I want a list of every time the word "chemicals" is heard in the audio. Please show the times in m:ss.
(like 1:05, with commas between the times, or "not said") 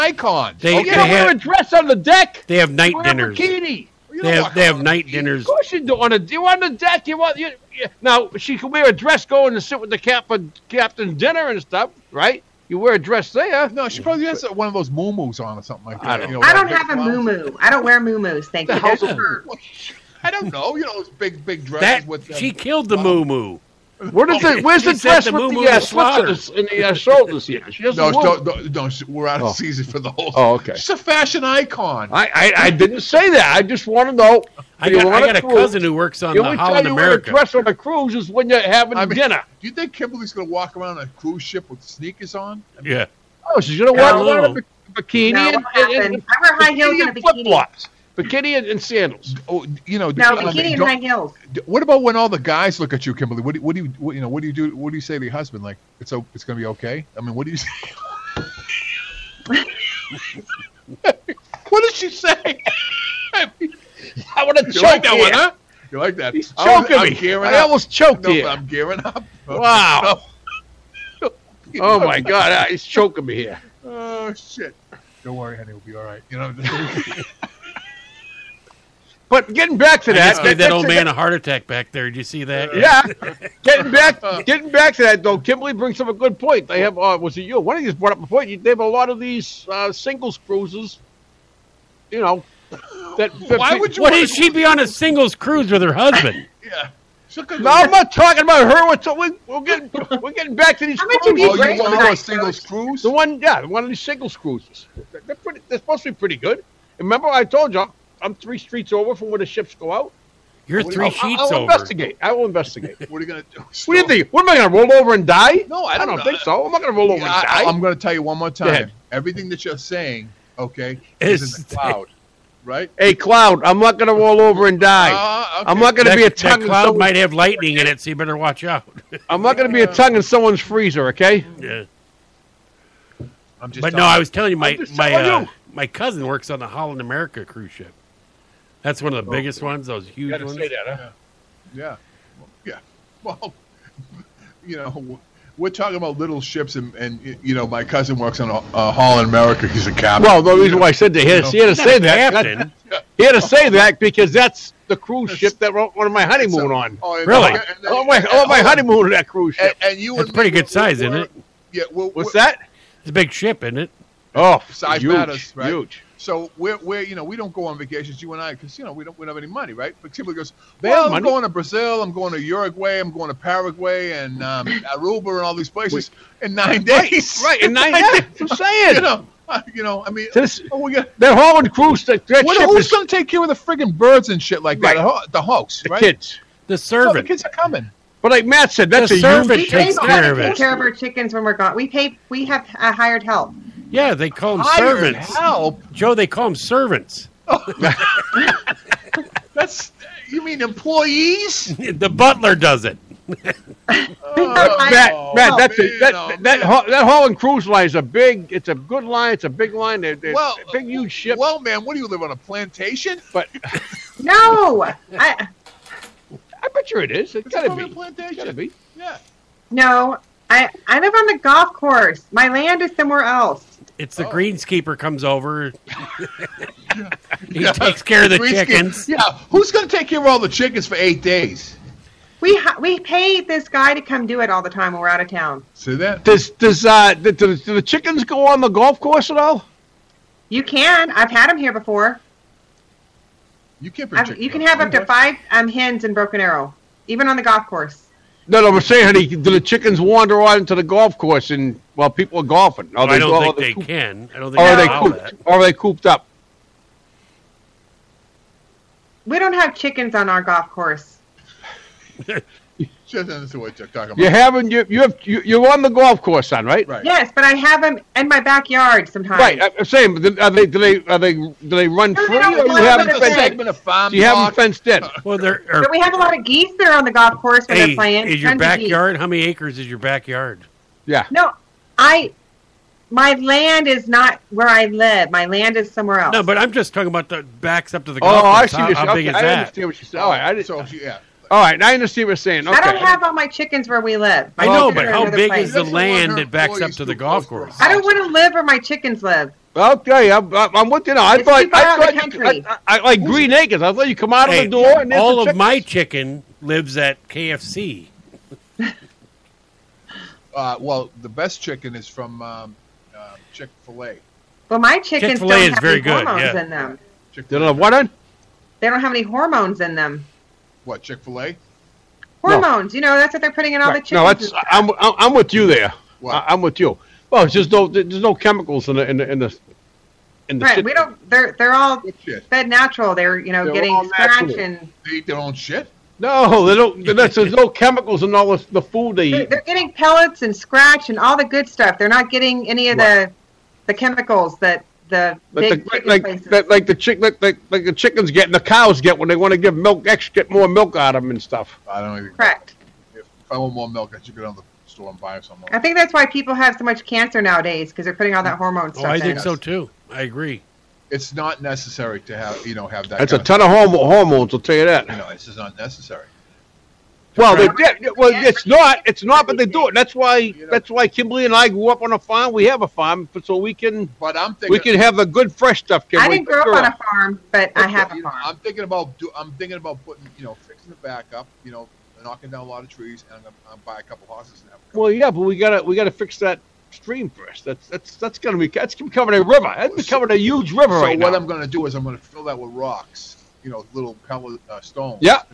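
5:28, 5:37, 5:43.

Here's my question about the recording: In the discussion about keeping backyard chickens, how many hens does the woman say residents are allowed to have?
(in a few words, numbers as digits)
5.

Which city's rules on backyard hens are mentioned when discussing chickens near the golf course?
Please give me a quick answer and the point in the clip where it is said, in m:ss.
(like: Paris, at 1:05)
Broken Arrow, at 4:06.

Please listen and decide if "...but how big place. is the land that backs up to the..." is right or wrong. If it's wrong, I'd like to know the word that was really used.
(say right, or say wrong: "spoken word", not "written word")
right.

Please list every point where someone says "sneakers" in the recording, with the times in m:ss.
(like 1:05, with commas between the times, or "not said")
0:41.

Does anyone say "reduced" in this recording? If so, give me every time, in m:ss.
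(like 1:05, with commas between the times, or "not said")
not said.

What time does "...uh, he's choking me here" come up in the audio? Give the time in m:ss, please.
1:12.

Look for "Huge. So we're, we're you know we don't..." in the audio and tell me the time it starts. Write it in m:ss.
2:45.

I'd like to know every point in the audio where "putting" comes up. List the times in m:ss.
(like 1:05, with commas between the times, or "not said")
5:23, 5:58, 6:20.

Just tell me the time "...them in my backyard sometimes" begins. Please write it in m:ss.
4:27.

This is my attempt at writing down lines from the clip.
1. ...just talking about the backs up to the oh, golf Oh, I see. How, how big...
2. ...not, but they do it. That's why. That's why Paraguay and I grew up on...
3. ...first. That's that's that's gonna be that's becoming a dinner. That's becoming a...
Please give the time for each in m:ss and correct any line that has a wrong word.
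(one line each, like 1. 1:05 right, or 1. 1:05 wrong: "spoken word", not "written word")
1. 4:46 right
2. 6:09 wrong: "Kimberly", not "Paraguay"
3. 6:27 wrong: "river", not "dinner".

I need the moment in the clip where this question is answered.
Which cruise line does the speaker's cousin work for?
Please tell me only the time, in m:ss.
2:16.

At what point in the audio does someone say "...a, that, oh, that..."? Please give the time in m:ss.
3:25.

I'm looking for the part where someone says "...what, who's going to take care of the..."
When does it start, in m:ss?
3:02.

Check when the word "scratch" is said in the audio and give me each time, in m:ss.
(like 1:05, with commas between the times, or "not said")
5:34, 5:40.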